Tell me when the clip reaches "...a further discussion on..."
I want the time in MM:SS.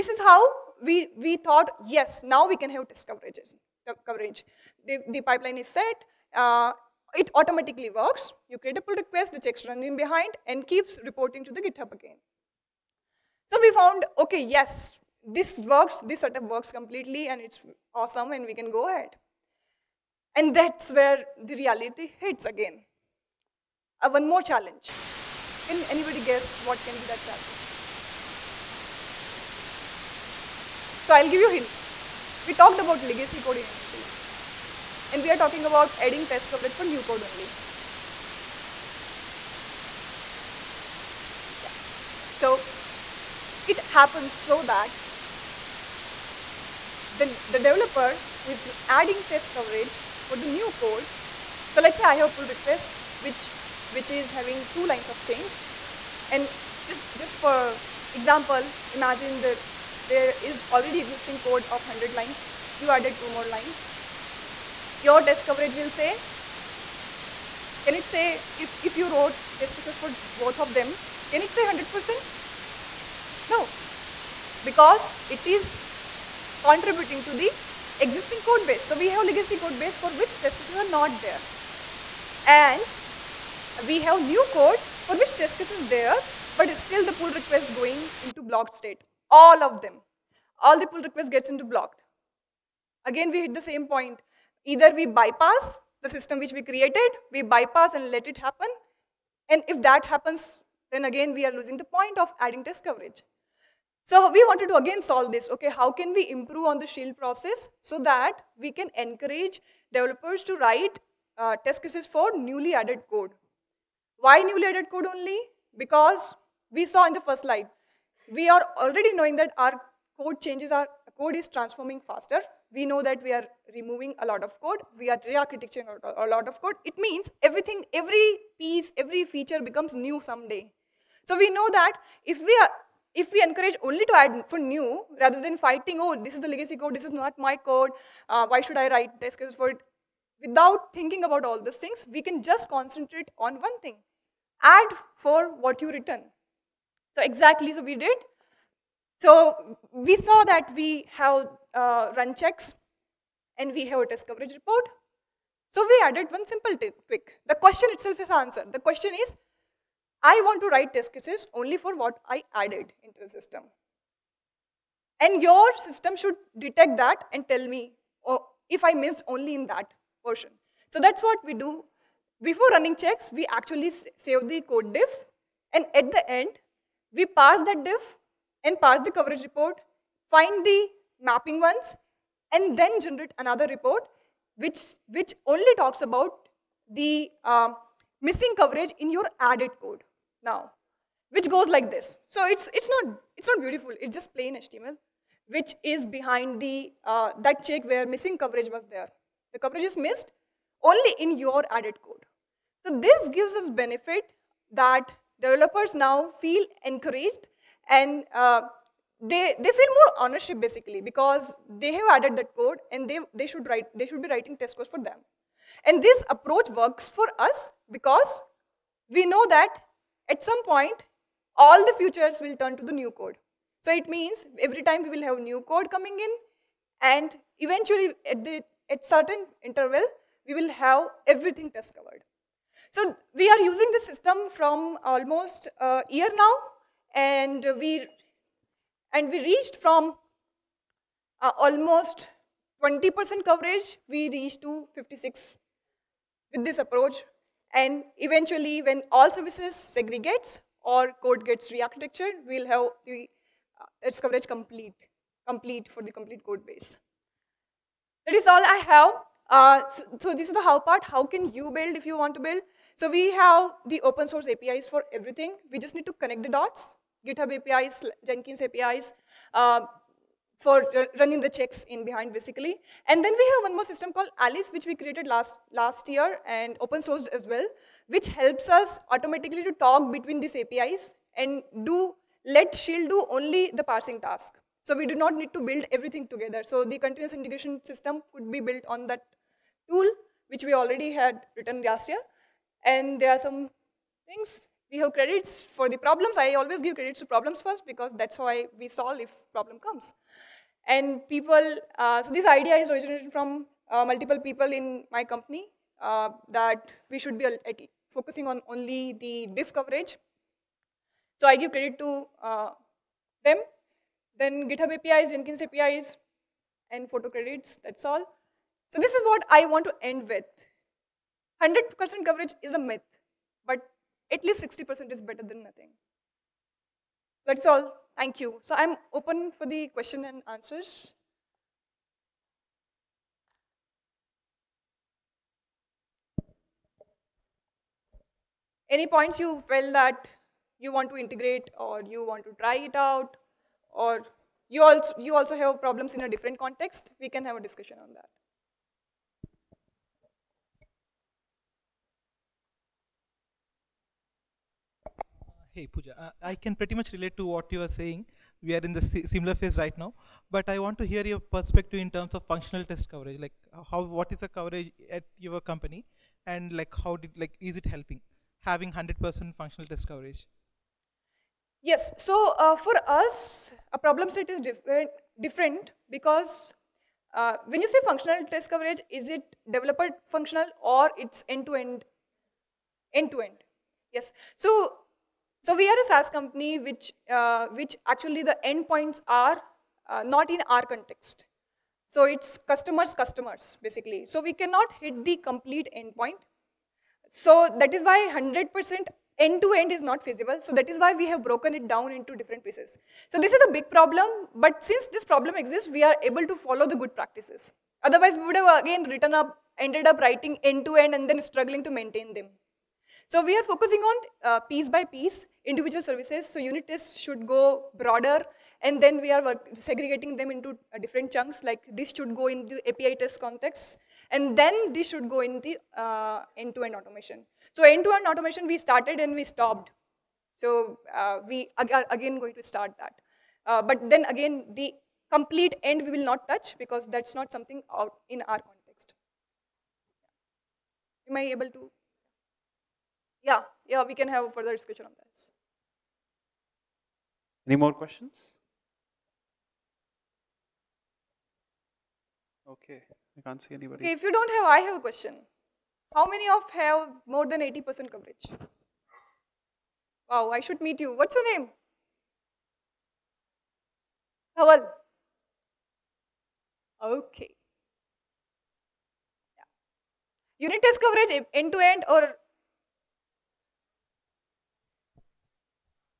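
07:24.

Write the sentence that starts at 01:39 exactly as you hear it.
And if that happens, then again we are losing the point of adding test coverage.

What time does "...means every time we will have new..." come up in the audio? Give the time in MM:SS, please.
03:44.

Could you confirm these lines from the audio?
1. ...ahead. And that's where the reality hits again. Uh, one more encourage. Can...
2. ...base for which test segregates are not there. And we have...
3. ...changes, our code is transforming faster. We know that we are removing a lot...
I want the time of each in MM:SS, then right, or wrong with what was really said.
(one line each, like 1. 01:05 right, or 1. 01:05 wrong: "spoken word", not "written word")
1. 00:18 wrong: "challenge", not "encourage"
2. 01:19 wrong: "cases", not "segregates"
3. 02:00 right.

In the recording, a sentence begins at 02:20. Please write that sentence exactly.
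Without thinking about all these things, we can just concentrate on one thing.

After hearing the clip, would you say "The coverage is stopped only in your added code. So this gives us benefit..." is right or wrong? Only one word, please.
wrong.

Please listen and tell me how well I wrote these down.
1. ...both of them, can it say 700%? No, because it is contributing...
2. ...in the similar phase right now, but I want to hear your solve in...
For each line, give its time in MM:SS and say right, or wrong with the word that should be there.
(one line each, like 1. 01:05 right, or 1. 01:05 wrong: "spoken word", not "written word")
1. 01:10 wrong: "100", not "700"
2. 05:58 wrong: "perspective", not "solve".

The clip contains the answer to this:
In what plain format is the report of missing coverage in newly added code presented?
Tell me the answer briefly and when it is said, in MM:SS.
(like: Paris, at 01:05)
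HTML, at 03:14.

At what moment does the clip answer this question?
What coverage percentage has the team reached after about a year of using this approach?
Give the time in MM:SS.
04:04.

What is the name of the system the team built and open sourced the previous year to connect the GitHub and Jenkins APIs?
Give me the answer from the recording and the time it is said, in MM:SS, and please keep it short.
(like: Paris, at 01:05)
Alice, at 04:34.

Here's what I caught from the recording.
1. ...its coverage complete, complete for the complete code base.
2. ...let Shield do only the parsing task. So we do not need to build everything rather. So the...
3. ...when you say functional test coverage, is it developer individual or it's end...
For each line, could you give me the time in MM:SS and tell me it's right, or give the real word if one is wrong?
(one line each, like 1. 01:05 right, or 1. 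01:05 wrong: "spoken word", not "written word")
1. 04:14 right
2. 04:42 wrong: "together", not "rather"
3. 06:17 wrong: "functional", not "individual".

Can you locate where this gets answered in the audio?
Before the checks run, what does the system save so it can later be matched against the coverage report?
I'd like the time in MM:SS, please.
02:54.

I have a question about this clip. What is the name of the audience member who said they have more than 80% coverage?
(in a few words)
Haval.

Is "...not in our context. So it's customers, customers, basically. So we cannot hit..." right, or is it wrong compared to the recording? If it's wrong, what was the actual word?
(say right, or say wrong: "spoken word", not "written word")
right.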